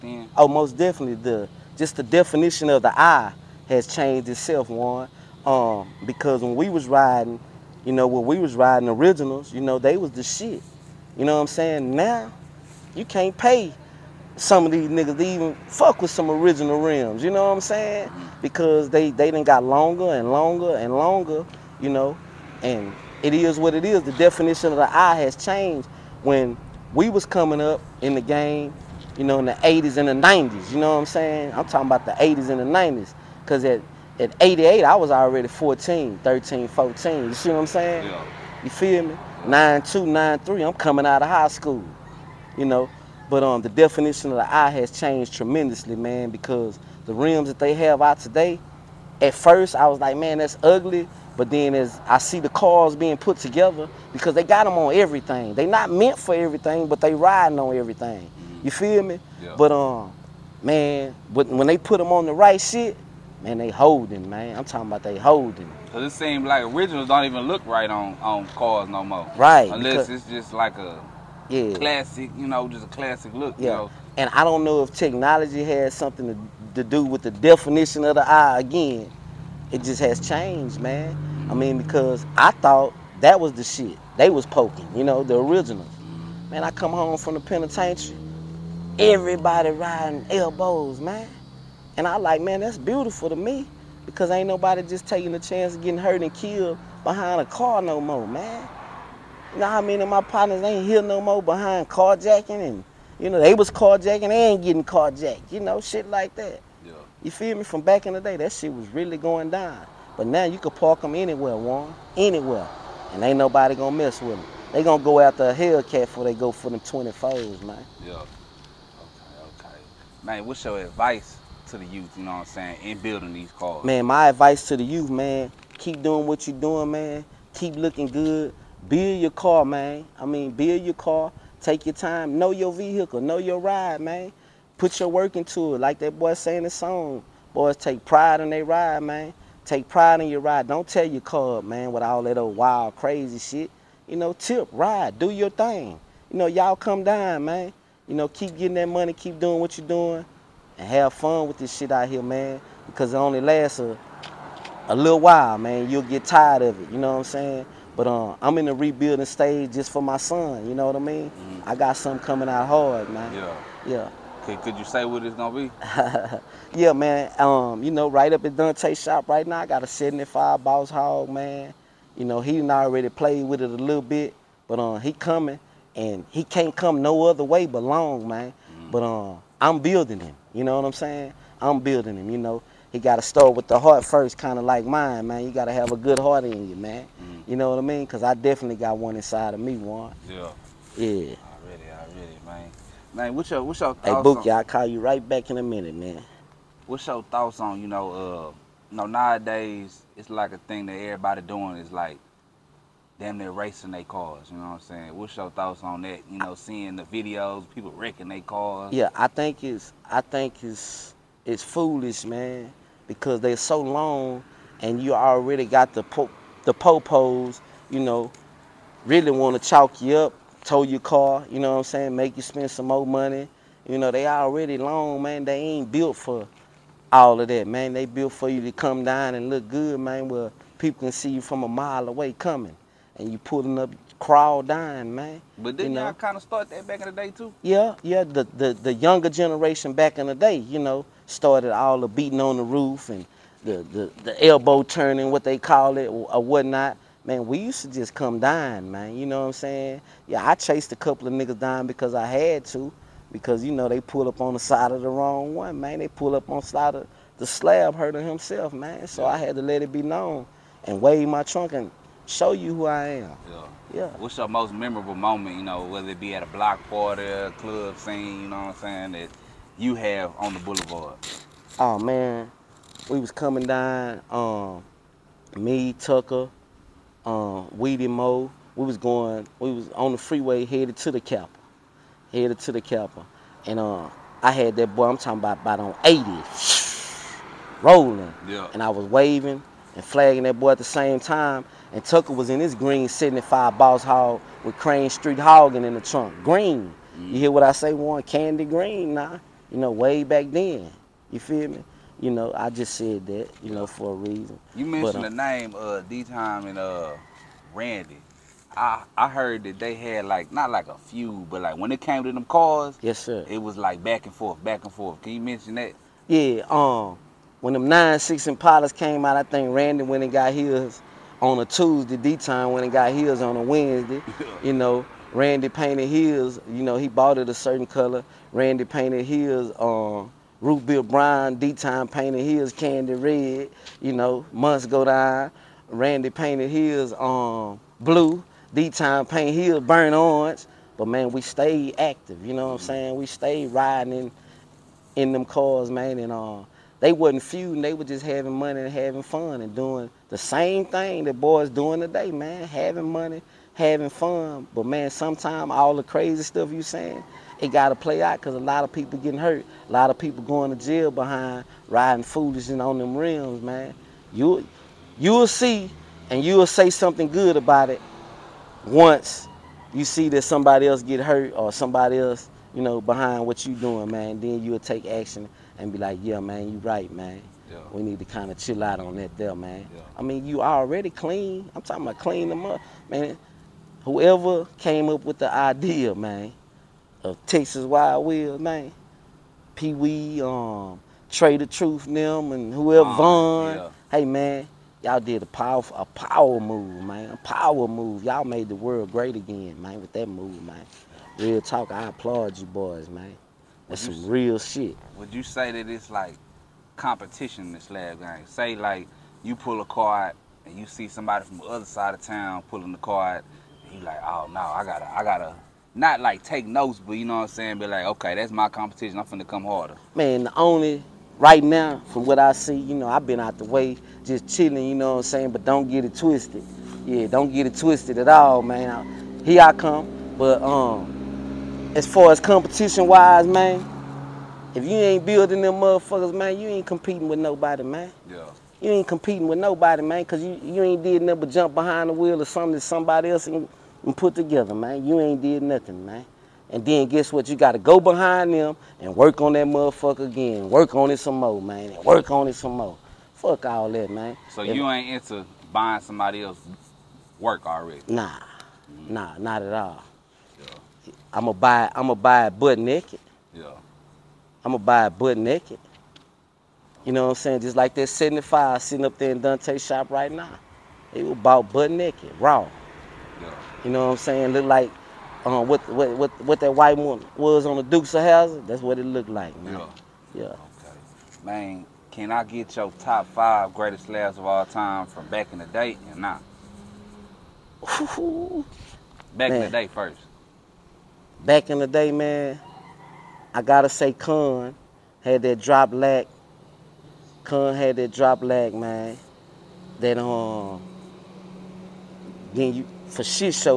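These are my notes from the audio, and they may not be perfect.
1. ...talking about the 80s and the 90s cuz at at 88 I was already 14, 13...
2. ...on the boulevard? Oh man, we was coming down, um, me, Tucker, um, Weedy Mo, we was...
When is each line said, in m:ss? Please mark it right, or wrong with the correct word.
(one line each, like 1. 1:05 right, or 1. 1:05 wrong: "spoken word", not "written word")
1. 0:31 right
2. 4:30 right.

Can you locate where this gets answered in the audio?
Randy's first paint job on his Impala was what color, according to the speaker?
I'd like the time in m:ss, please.
5:30.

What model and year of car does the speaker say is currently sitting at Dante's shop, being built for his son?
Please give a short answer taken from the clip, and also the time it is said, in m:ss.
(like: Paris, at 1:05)
75 Boss Hog, at 2:49.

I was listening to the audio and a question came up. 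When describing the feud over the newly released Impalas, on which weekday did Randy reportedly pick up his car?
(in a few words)
Tuesday.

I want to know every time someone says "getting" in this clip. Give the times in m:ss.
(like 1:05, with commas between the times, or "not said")
1:35, 1:44, 2:28, 5:59.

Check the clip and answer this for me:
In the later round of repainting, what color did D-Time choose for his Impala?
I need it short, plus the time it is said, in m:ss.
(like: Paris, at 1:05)
burnt orange, at 5:39.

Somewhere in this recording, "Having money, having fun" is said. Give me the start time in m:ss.
5:52.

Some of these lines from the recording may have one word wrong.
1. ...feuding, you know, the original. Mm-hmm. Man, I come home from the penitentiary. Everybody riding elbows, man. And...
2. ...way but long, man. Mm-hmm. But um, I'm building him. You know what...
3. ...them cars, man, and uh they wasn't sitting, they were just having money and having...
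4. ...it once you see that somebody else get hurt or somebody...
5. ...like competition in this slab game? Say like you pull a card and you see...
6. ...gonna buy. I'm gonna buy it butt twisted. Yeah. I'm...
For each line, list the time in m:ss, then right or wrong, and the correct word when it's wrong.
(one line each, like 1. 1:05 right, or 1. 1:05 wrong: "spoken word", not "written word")
1. 1:24 wrong: "poking", not "feuding"
2. 2:57 right
3. 5:45 wrong: "feuding", not "sitting"
4. 6:07 right
5. 6:46 right
6. 7:41 wrong: "naked", not "twisted".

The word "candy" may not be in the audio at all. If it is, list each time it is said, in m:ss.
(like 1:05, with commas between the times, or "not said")
4:58, 5:32.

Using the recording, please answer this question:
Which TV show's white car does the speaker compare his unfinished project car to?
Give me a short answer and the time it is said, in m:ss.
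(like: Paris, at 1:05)
Dukes of Hazzard, at 7:57.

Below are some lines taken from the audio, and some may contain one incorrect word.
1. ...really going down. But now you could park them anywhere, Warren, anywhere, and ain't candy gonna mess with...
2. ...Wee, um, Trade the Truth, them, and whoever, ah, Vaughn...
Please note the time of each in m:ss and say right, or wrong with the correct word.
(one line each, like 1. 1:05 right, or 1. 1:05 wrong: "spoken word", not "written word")
1. 1:48 wrong: "nobody", not "candy"
2. 6:29 right.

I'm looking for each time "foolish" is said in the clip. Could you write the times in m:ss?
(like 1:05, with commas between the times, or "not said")
3:31, 6:02.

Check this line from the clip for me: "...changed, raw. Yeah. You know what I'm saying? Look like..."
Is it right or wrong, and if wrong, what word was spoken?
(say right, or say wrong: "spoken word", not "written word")
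wrong: "naked", not "changed".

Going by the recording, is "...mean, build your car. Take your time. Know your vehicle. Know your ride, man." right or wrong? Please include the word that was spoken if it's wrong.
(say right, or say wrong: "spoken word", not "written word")
right.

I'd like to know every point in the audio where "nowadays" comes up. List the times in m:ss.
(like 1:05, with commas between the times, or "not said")
3:19.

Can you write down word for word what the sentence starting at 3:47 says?
They built for you to come down and look good, man, where people can see you from a mile away coming.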